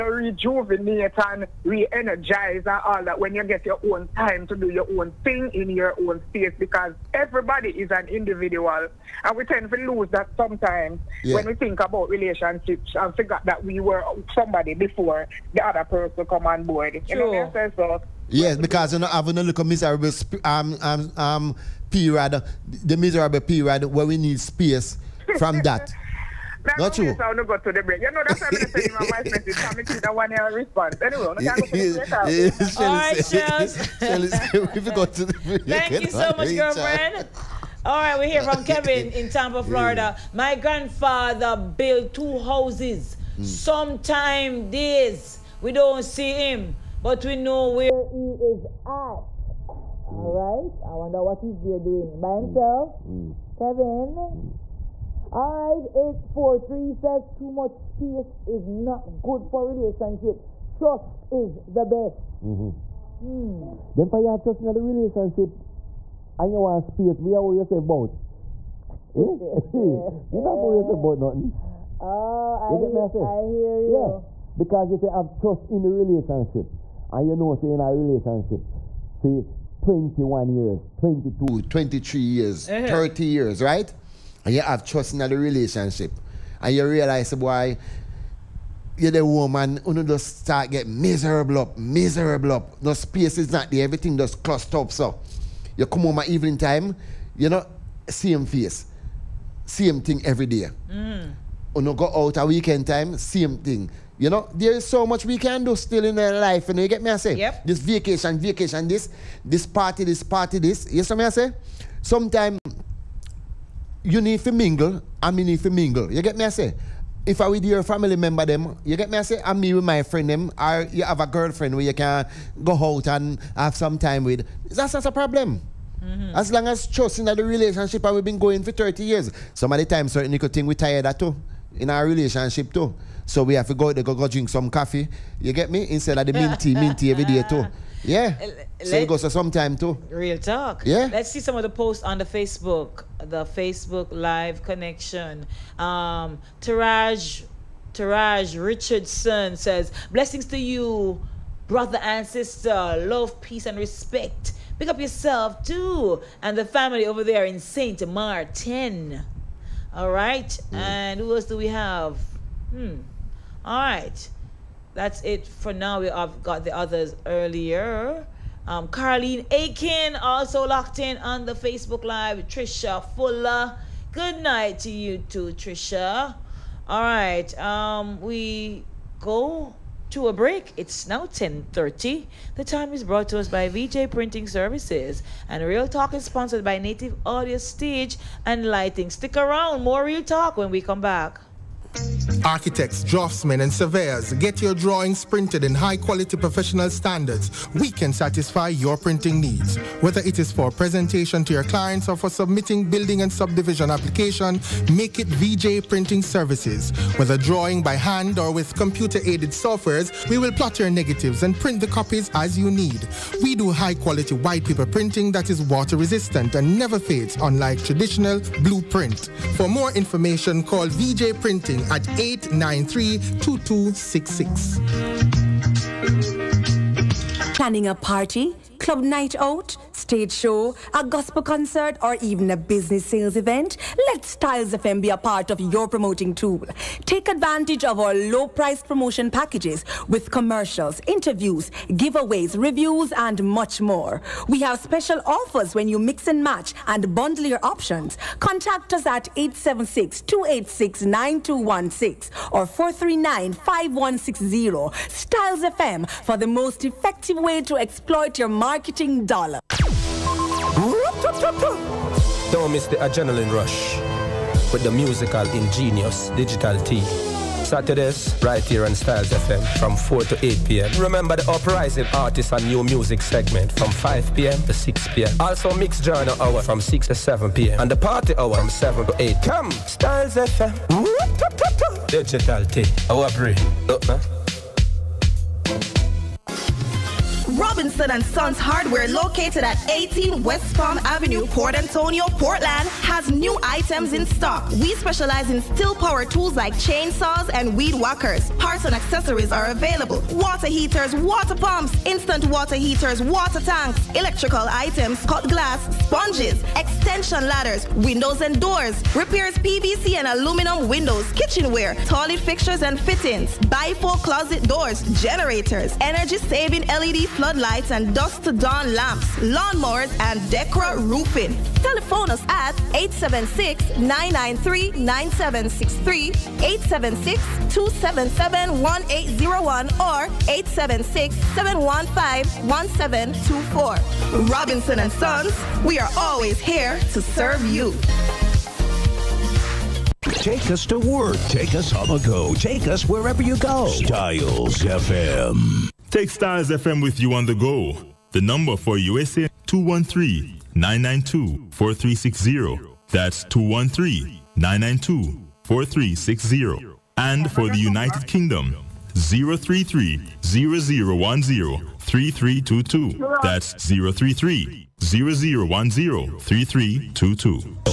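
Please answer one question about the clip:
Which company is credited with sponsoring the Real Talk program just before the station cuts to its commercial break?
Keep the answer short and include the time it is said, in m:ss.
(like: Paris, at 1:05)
Native Audio Stage and Lighting, at 3:06.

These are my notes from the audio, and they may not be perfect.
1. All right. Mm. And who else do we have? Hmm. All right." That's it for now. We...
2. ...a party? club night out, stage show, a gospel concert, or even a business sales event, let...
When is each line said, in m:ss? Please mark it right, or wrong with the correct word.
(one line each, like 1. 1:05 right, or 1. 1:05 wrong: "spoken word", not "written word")
1. 2:39 right
2. 3:47 right.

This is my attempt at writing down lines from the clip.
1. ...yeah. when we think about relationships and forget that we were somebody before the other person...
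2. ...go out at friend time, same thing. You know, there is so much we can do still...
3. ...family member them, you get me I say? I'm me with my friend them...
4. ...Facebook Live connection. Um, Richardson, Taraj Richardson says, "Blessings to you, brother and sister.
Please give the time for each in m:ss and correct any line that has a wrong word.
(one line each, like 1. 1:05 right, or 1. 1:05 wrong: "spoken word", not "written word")
1. 0:11 right
2. 1:41 wrong: "weekend", not "friend"
3. 1:57 right
4. 2:23 wrong: "Taraj", not "Richardson".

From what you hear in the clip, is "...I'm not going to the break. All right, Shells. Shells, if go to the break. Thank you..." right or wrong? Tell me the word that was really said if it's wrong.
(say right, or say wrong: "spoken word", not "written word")
right.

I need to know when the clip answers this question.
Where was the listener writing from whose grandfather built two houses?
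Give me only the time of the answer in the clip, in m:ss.
0:39.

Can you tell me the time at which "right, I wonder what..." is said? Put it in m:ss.
0:50.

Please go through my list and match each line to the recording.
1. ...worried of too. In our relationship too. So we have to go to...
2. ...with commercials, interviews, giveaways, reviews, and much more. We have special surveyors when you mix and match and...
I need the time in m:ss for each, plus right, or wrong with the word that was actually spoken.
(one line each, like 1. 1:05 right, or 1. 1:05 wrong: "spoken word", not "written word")
1. 2:10 wrong: "tired", not "worried"
2. 4:00 wrong: "offers", not "surveyors".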